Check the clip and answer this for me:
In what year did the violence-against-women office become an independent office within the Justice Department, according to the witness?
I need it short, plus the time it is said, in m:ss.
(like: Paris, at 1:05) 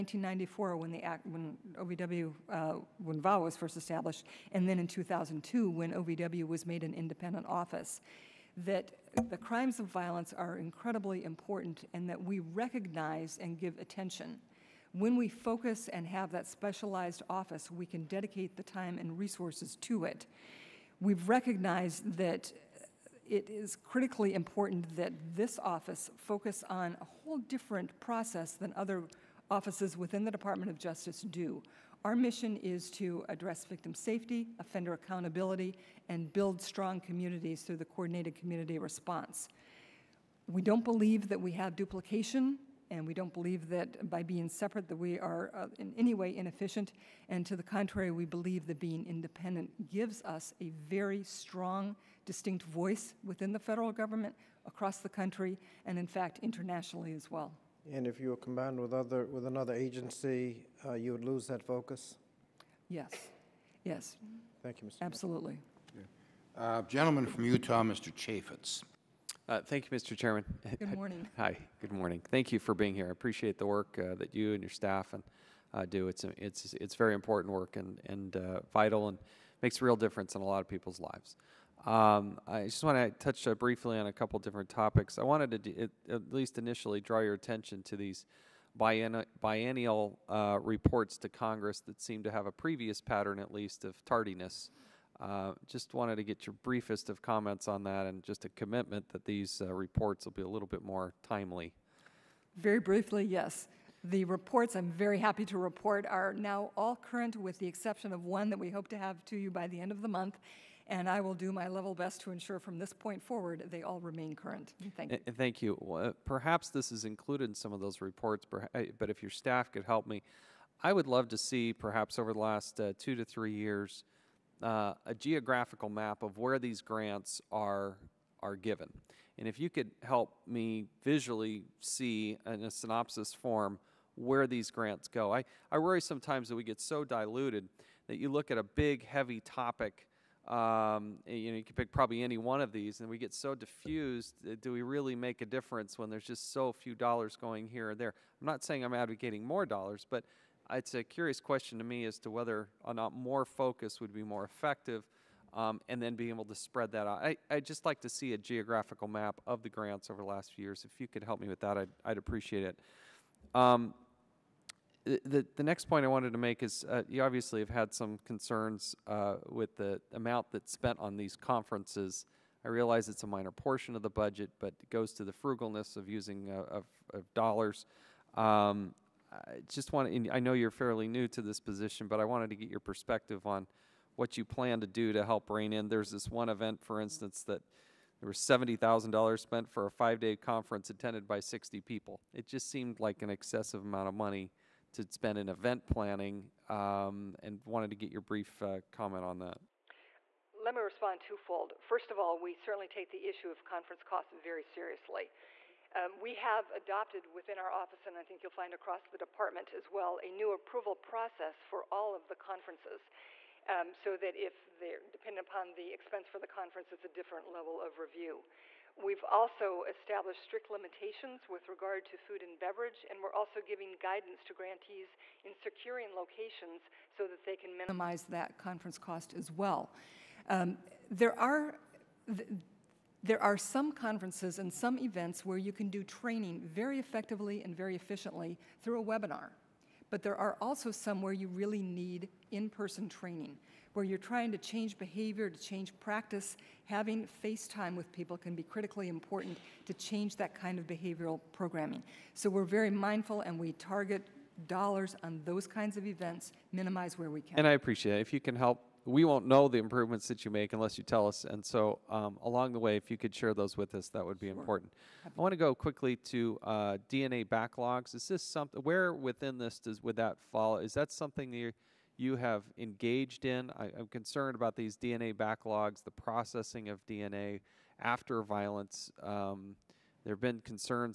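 2002, at 0:04.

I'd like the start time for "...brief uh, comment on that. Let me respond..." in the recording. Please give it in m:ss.
3:18.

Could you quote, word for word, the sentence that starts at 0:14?
When we focus and have that specialized office, we can dedicate the time and resources to it.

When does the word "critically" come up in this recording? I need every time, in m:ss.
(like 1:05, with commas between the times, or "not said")
0:23, 4:08.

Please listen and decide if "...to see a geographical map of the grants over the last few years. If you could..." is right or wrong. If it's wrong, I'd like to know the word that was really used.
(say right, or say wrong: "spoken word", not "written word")
right.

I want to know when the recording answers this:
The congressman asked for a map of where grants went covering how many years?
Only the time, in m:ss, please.
2:02.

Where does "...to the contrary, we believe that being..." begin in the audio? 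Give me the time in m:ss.
0:47.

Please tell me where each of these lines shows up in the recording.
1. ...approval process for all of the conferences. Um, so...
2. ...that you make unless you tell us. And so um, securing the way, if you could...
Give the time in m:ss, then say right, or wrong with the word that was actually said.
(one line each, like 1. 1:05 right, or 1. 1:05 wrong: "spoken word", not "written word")
1. 3:30 right
2. 4:20 wrong: "along", not "securing".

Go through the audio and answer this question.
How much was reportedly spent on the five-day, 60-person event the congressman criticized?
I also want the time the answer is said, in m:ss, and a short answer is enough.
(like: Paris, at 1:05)
$70,000, at 3:08.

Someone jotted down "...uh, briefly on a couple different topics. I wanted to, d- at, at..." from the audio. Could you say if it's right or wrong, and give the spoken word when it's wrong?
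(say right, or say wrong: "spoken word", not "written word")
right.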